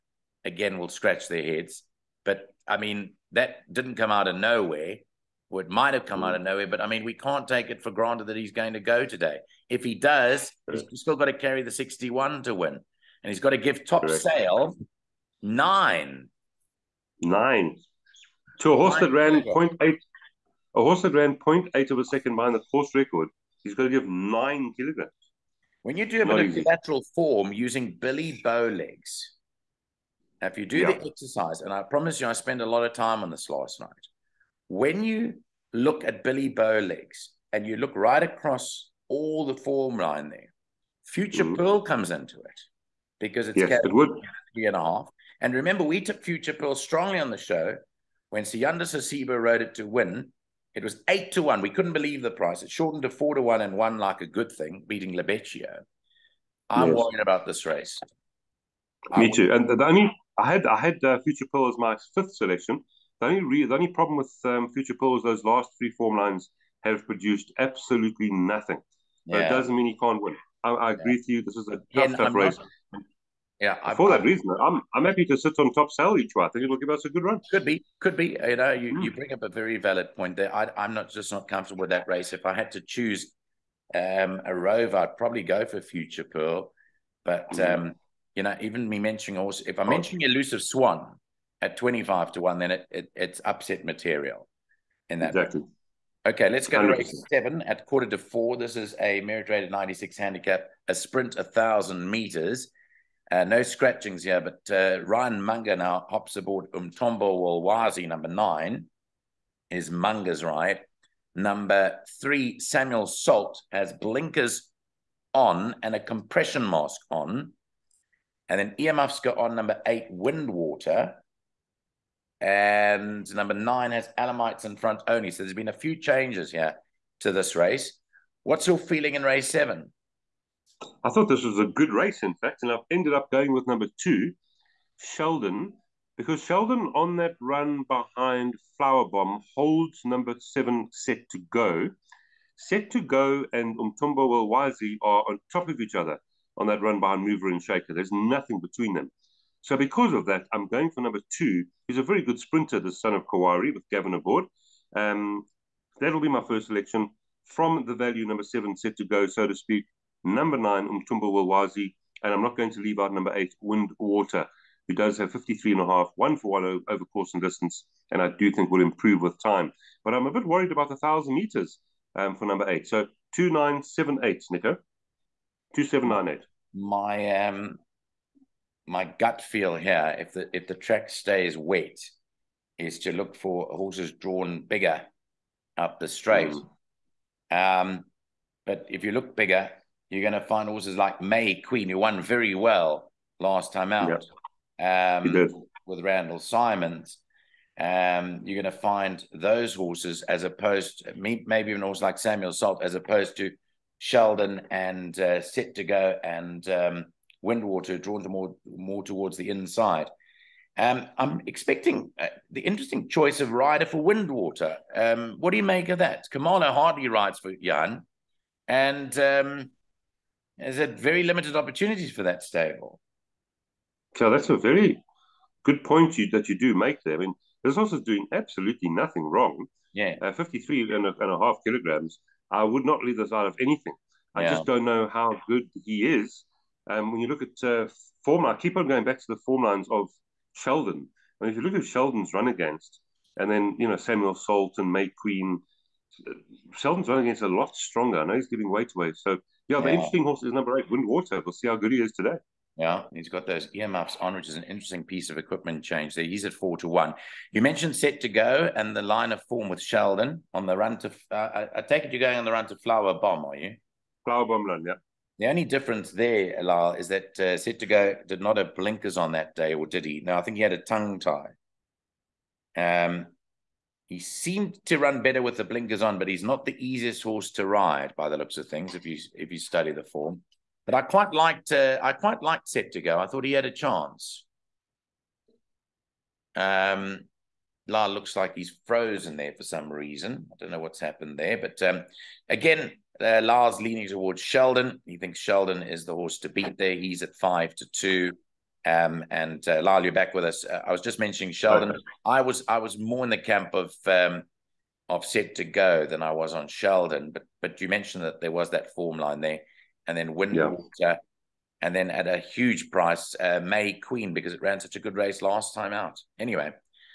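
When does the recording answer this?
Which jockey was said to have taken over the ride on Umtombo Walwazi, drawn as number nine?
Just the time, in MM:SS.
01:45.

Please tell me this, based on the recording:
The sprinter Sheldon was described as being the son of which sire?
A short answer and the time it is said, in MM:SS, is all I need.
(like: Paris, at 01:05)
Kawari, at 02:33.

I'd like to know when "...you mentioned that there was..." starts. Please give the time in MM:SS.
05:07.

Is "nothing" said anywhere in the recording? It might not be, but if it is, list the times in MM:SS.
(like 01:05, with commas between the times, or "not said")
01:08, 02:28, 03:48.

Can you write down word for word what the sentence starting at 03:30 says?
Um, I'm expecting uh, the interesting choice of rider for Windwater.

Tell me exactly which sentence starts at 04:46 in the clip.
Um, La looks like he's frozen there for some reason.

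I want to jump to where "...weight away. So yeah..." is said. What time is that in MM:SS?
04:08.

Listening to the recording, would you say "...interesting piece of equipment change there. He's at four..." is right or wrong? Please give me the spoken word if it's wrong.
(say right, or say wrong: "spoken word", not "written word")
right.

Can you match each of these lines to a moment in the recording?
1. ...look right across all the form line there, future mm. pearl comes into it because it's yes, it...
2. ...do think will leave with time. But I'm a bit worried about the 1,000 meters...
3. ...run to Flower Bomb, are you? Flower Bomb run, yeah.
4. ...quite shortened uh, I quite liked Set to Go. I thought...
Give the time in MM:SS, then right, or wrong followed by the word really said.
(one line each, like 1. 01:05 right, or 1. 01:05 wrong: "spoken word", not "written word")
1. 00:37 right
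2. 02:48 wrong: "improve", not "leave"
3. 04:22 right
4. 04:41 wrong: "liked", not "shortened".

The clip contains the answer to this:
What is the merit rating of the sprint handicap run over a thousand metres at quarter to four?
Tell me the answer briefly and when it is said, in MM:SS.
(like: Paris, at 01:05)
96, at 01:39.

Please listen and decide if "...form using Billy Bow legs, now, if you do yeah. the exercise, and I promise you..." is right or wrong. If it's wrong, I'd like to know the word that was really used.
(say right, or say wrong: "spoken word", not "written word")
right.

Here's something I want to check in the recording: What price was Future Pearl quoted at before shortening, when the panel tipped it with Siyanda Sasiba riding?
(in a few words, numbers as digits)
8 to 1.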